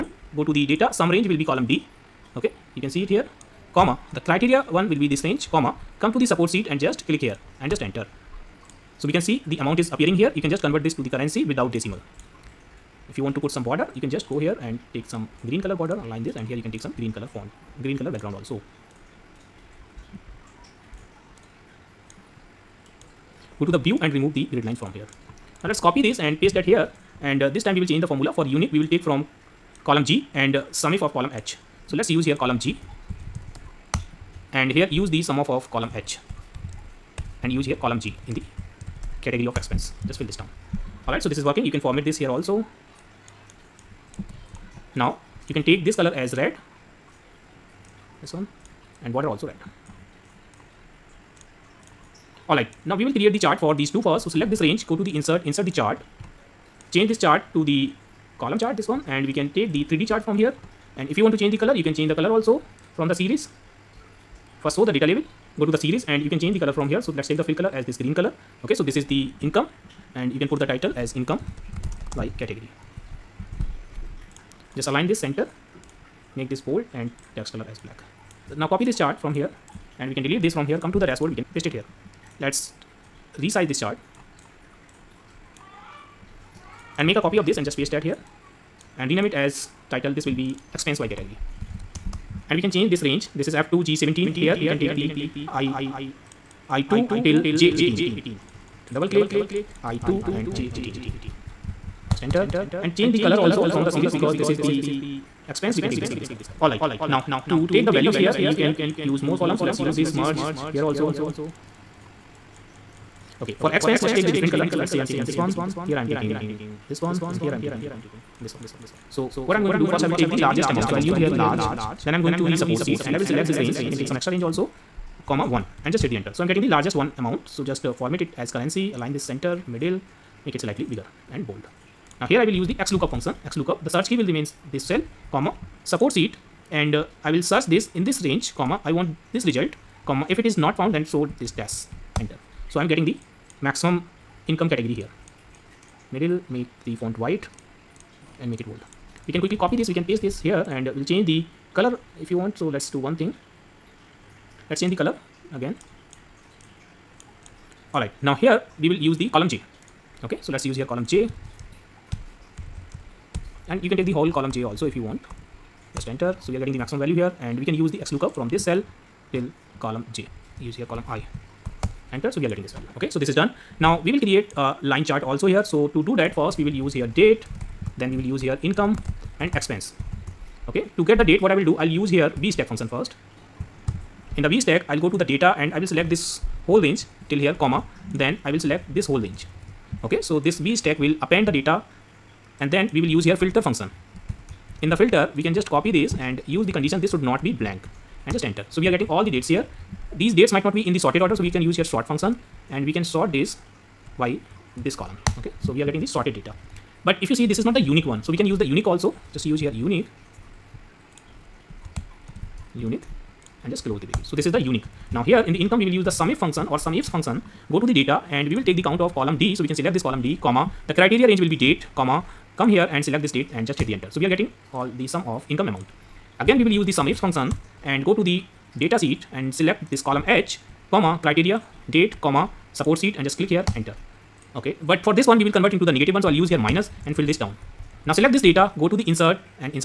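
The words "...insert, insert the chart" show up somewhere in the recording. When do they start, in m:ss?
0:55.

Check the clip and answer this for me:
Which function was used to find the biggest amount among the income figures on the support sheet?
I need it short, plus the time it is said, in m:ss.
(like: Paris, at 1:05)
LARGE, at 2:01.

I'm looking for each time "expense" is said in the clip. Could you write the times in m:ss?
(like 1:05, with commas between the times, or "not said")
0:39, 1:30, 1:45, 2:59.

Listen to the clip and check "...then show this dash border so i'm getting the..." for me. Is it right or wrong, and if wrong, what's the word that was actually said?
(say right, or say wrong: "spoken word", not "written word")
wrong: "enter", not "border".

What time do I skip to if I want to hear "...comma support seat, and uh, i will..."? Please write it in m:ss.
2:15.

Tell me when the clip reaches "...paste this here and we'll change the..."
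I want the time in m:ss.
2:30.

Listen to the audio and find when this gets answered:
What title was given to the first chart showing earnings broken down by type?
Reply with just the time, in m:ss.
1:11.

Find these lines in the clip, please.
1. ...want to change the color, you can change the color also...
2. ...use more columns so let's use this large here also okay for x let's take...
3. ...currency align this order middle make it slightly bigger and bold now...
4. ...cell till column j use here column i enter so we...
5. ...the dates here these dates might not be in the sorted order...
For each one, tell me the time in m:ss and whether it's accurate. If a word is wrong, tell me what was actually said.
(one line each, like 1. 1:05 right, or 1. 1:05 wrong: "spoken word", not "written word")
1. 1:01 right
2. 1:49 wrong: "merge", not "large"
3. 2:08 wrong: "center", not "order"
4. 2:48 right
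5. 3:19 right.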